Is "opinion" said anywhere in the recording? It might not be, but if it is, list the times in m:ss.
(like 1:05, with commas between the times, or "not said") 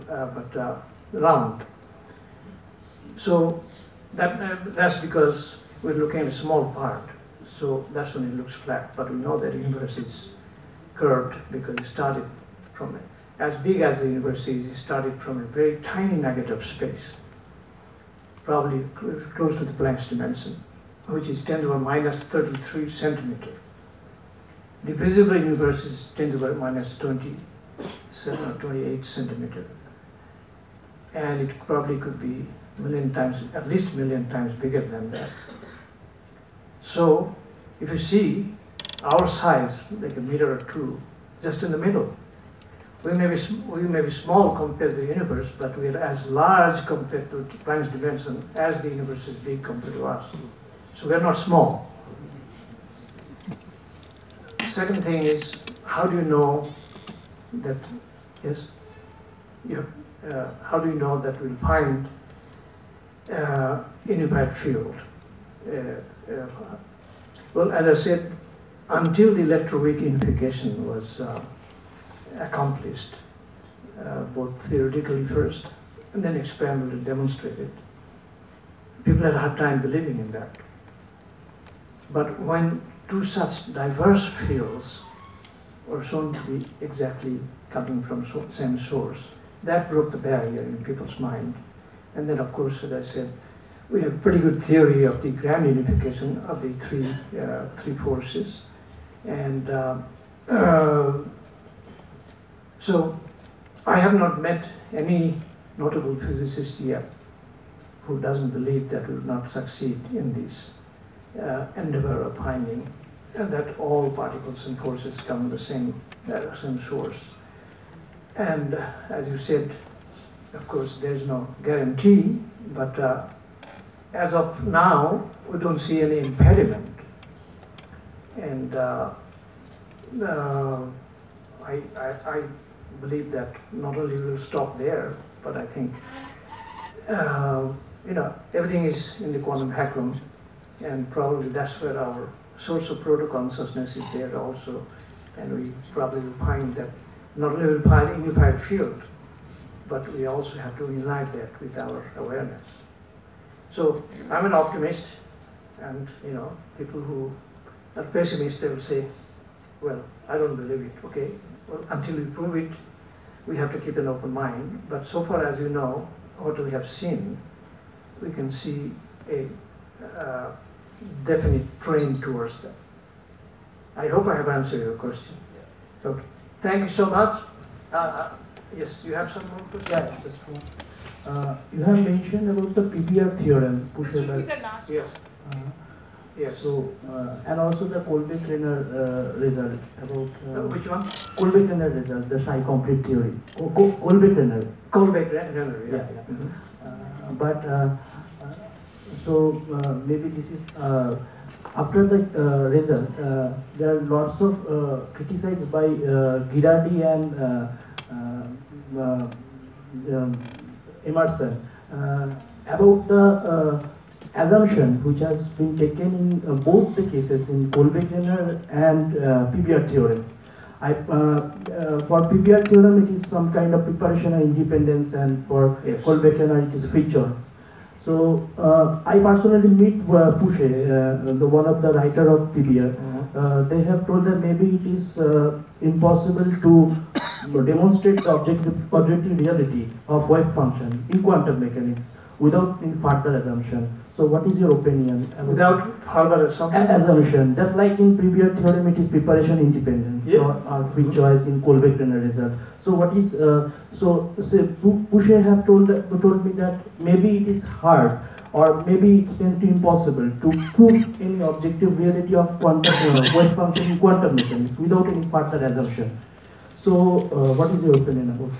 4:04, 4:27.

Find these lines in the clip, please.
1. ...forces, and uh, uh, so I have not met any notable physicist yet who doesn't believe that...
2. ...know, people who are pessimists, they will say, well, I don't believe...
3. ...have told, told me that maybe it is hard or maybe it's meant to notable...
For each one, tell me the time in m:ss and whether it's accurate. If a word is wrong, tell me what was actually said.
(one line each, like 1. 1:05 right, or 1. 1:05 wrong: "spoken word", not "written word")
1. 1:37 right
2. 2:36 right
3. 4:15 wrong: "impossible", not "notable".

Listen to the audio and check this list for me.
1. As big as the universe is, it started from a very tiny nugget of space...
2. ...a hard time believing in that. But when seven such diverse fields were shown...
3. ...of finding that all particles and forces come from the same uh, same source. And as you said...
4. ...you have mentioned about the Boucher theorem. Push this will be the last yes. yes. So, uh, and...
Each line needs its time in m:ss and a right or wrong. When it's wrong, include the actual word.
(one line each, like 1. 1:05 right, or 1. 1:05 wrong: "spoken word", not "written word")
1. 0:13 right
2. 1:19 wrong: "two", not "seven"
3. 1:52 right
4. 3:01 wrong: "PBR", not "Boucher".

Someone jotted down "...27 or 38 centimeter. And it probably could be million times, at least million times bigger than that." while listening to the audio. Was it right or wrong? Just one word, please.
wrong.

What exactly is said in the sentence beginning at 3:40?
I, uh, uh for PBR theorem, it is some kind of preparation and independence, and for yes.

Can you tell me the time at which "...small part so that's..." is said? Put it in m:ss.
0:06.